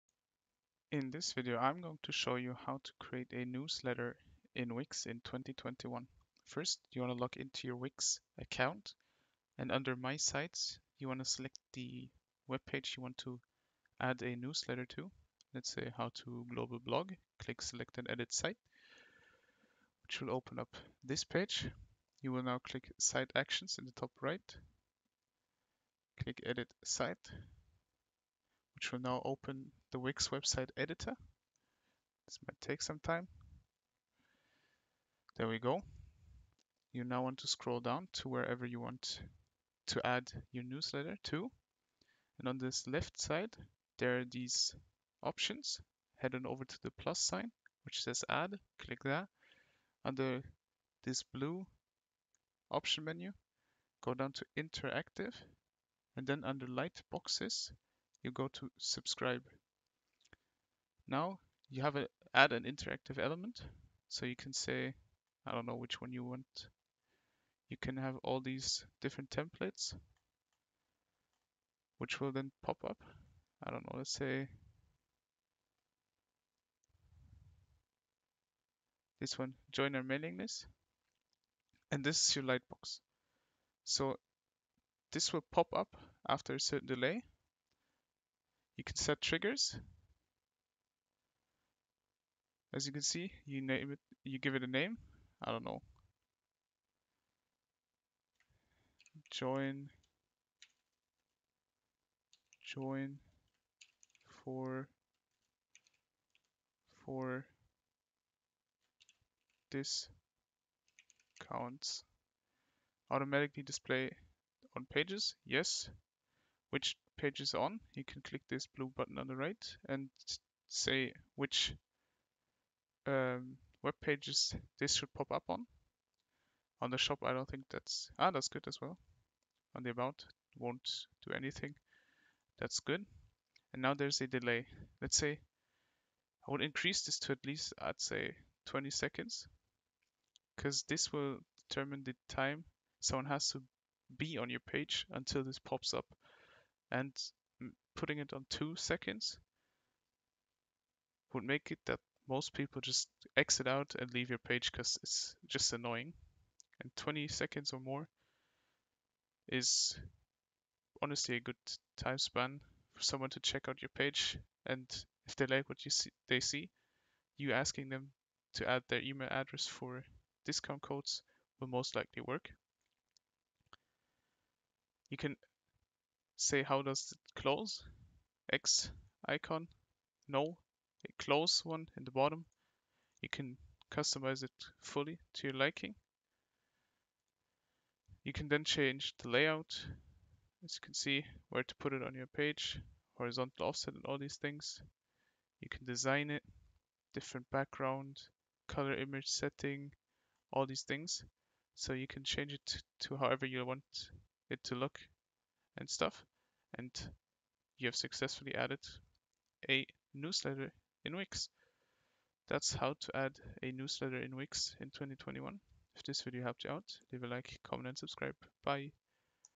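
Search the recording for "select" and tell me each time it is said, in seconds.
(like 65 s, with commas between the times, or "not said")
11 s, 17 s.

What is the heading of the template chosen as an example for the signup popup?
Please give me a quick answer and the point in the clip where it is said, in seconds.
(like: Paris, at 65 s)
Join our mailing list, at 79 s.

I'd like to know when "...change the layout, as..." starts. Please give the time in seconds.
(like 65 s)
188 s.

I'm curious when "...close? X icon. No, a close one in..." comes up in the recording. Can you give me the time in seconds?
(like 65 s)
177 s.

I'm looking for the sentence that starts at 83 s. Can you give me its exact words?
So this will pop up after a certain delay you can set triggers.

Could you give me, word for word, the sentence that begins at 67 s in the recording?
You can have all these different templates, which will then pop up.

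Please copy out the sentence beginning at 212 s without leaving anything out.
That's how to add a newsletter in Wix in 2021.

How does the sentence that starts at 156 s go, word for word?
And 20 seconds or more is honestly a good time span for someone to check out your page.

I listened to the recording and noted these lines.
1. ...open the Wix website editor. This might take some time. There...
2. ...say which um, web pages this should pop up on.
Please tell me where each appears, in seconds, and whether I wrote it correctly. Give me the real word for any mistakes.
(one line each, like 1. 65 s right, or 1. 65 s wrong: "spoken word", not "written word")
1. 29 s right
2. 120 s right.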